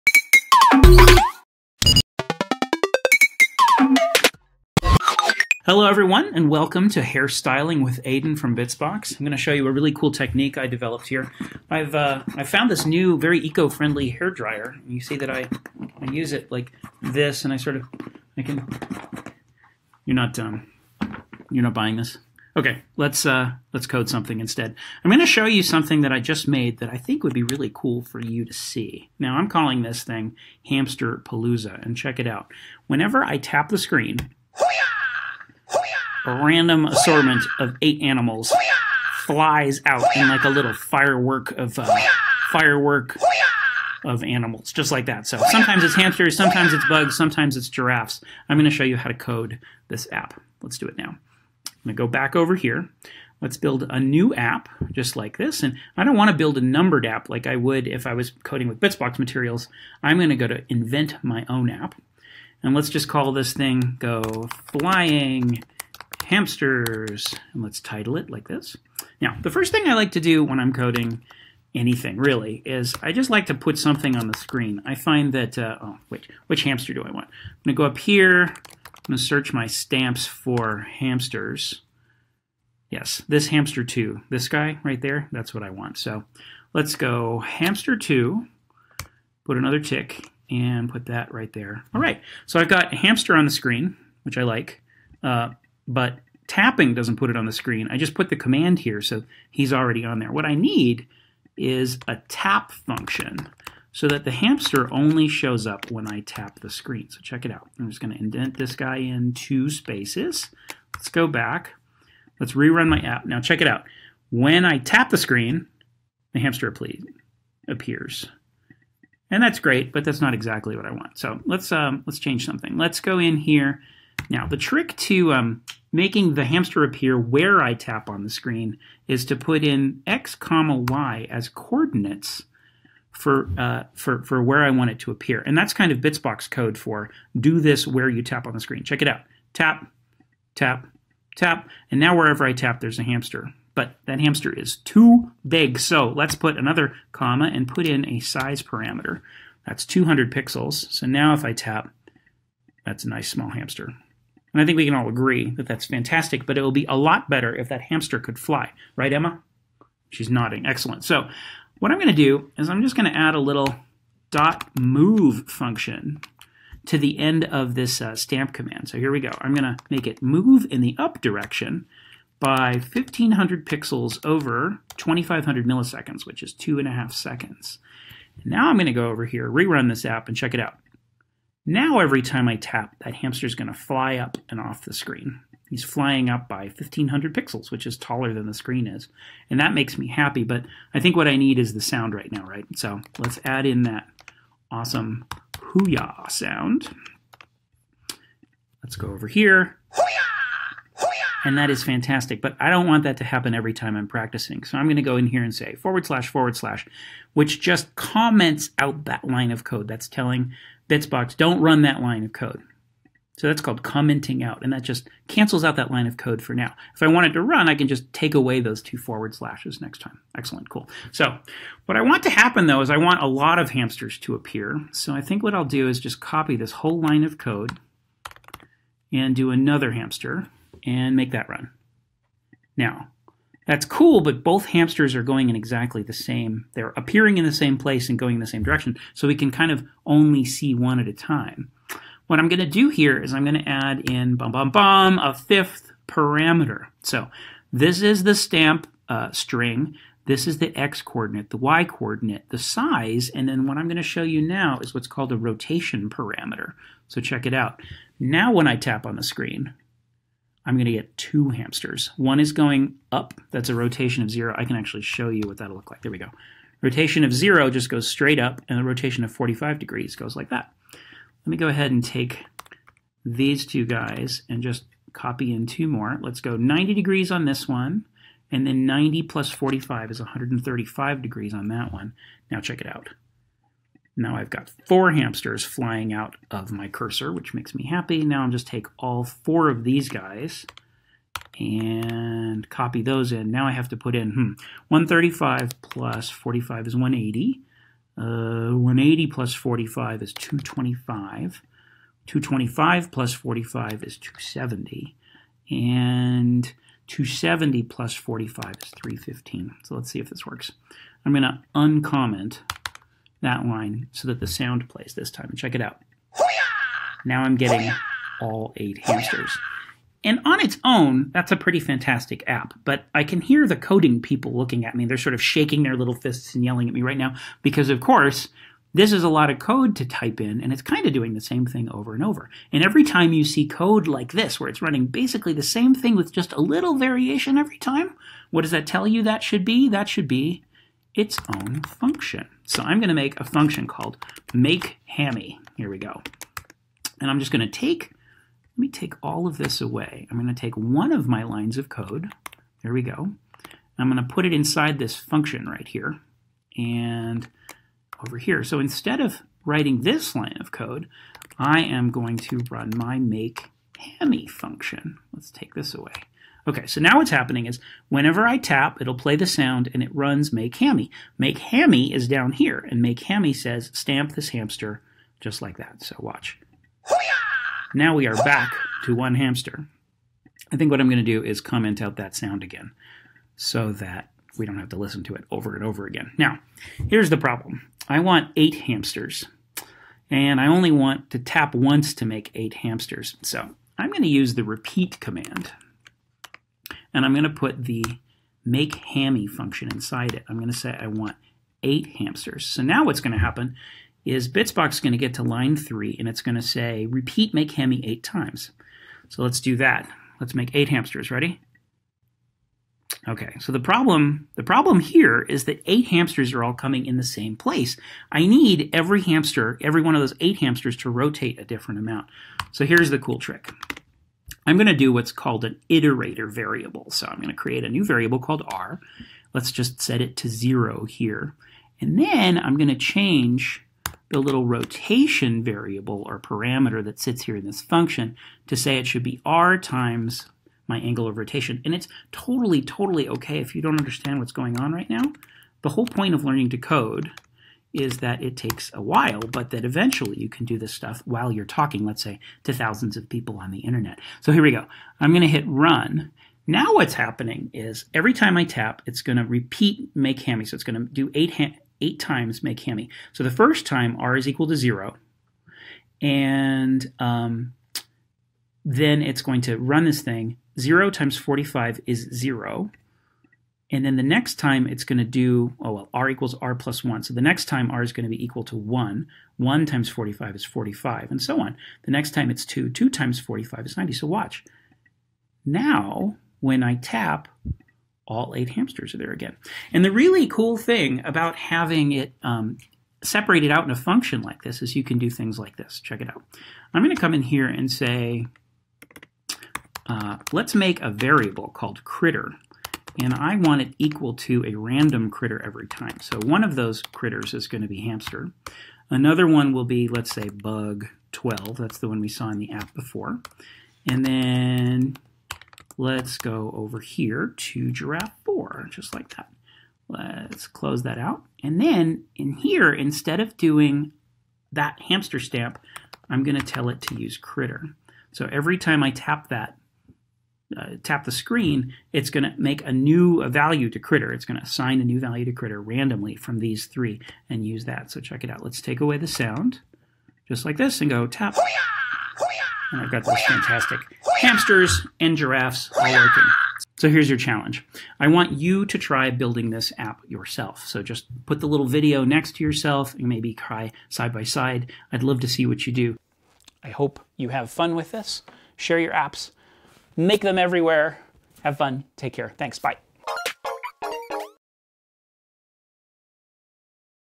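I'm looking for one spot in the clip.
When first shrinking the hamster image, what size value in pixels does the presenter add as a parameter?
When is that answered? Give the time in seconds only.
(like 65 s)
149 s.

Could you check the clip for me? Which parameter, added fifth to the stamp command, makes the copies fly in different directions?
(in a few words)
rotation parameter.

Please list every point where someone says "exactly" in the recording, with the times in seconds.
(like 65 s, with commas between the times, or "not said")
120 s, 235 s.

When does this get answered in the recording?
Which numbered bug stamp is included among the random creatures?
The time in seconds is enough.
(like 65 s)
510 s.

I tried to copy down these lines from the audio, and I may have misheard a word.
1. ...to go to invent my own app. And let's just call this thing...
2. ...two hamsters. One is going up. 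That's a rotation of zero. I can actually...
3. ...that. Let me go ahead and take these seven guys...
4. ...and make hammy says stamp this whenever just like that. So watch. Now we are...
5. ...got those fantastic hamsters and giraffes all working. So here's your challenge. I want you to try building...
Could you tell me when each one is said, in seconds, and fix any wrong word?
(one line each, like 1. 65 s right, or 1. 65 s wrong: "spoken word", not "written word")
1. 60 s right
2. 261 s right
3. 270 s wrong: "two", not "seven"
4. 372 s wrong: "hamster", not "whenever"
5. 543 s right.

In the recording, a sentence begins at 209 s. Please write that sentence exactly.
That's telling Bitsbox, don't run that line of code.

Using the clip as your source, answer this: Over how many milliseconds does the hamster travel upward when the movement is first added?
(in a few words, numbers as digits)
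2500.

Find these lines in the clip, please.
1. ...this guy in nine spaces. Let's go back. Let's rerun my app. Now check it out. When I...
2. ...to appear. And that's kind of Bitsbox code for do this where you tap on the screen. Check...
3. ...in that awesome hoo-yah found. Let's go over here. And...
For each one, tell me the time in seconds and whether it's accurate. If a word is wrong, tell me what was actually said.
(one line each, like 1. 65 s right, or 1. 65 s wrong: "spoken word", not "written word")
1. 108 s wrong: "two", not "nine"
2. 134 s right
3. 193 s wrong: "sound", not "found".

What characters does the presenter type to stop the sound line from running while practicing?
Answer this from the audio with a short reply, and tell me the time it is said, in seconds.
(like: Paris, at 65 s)
forward slash forward slash, at 205 s.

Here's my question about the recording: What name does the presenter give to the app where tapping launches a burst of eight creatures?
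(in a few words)
Hamsterpalooza.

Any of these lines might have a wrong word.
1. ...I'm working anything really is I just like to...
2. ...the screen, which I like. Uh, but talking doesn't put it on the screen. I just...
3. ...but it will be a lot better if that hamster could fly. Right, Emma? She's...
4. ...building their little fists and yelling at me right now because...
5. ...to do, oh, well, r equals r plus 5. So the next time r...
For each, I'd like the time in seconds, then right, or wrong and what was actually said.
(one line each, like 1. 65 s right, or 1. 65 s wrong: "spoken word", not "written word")
1. 70 s wrong: "coding", not "working"
2. 93 s wrong: "tapping", not "talking"
3. 156 s right
4. 325 s wrong: "shaking", not "building"
5. 475 s wrong: "1", not "5".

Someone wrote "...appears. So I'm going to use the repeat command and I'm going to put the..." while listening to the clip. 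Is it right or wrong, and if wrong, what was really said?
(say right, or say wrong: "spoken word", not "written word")
wrong: "hamsters", not "appears".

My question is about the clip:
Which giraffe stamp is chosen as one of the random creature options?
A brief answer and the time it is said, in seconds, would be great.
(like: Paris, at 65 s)
giraffe 4, at 517 s.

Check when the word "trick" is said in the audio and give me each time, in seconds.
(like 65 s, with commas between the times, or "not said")
124 s, 423 s.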